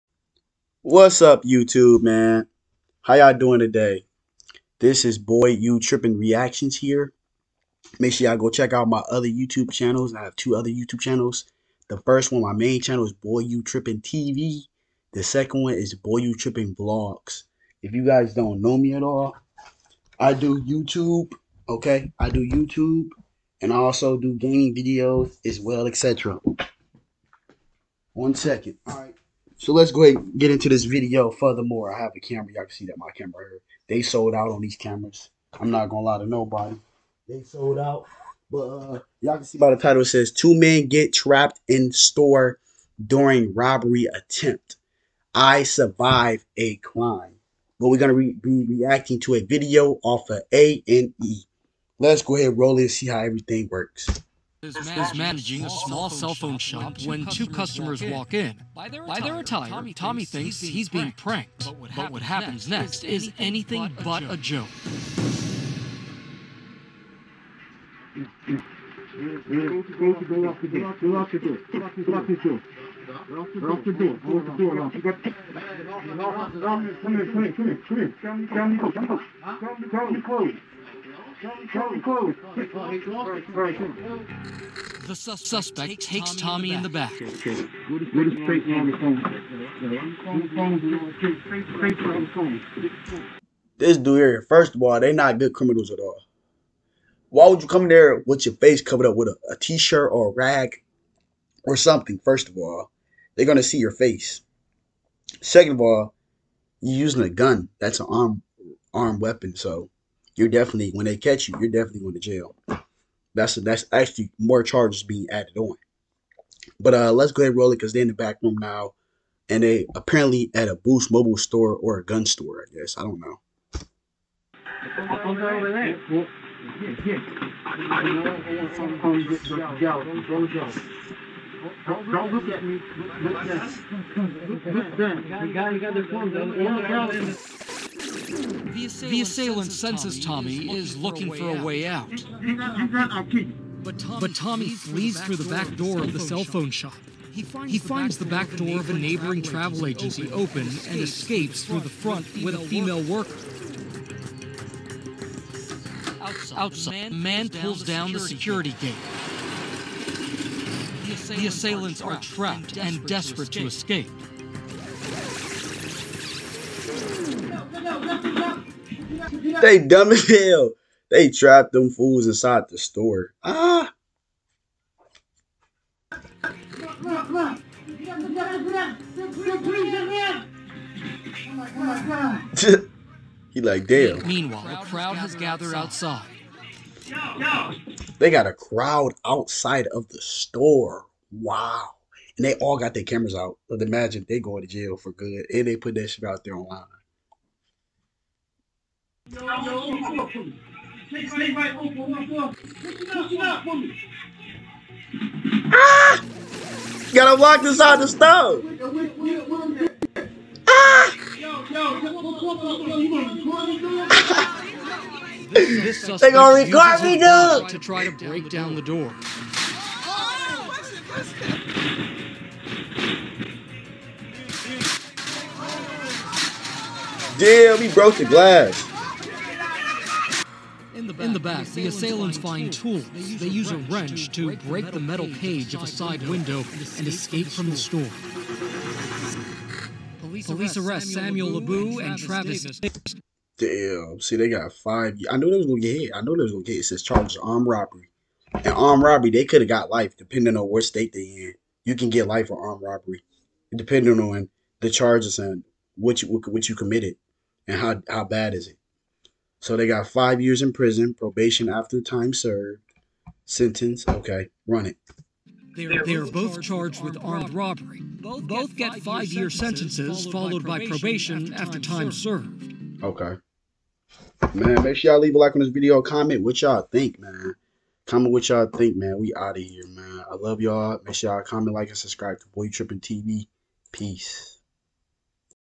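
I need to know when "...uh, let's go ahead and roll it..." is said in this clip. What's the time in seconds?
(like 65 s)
116 s.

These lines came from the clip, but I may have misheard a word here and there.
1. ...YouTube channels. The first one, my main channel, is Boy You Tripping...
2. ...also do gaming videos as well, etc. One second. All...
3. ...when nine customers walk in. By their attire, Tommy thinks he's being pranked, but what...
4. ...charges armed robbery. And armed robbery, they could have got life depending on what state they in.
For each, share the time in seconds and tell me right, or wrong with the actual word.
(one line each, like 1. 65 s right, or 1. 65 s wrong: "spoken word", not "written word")
1. 10 s right
2. 23 s right
3. 57 s wrong: "two", not "nine"
4. 247 s right.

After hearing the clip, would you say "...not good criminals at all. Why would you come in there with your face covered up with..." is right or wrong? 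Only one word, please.
right.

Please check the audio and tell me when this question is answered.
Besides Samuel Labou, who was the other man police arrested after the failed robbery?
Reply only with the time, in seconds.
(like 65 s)
242 s.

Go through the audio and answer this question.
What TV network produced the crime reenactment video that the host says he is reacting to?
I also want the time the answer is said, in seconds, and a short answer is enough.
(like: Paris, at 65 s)
A&E, at 50 s.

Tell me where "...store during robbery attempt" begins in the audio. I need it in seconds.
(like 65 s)
41 s.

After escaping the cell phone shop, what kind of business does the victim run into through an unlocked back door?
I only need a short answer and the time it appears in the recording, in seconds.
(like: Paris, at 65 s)
travel agency, at 149 s.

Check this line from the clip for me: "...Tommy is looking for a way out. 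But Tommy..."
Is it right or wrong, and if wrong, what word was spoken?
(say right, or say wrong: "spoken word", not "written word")
right.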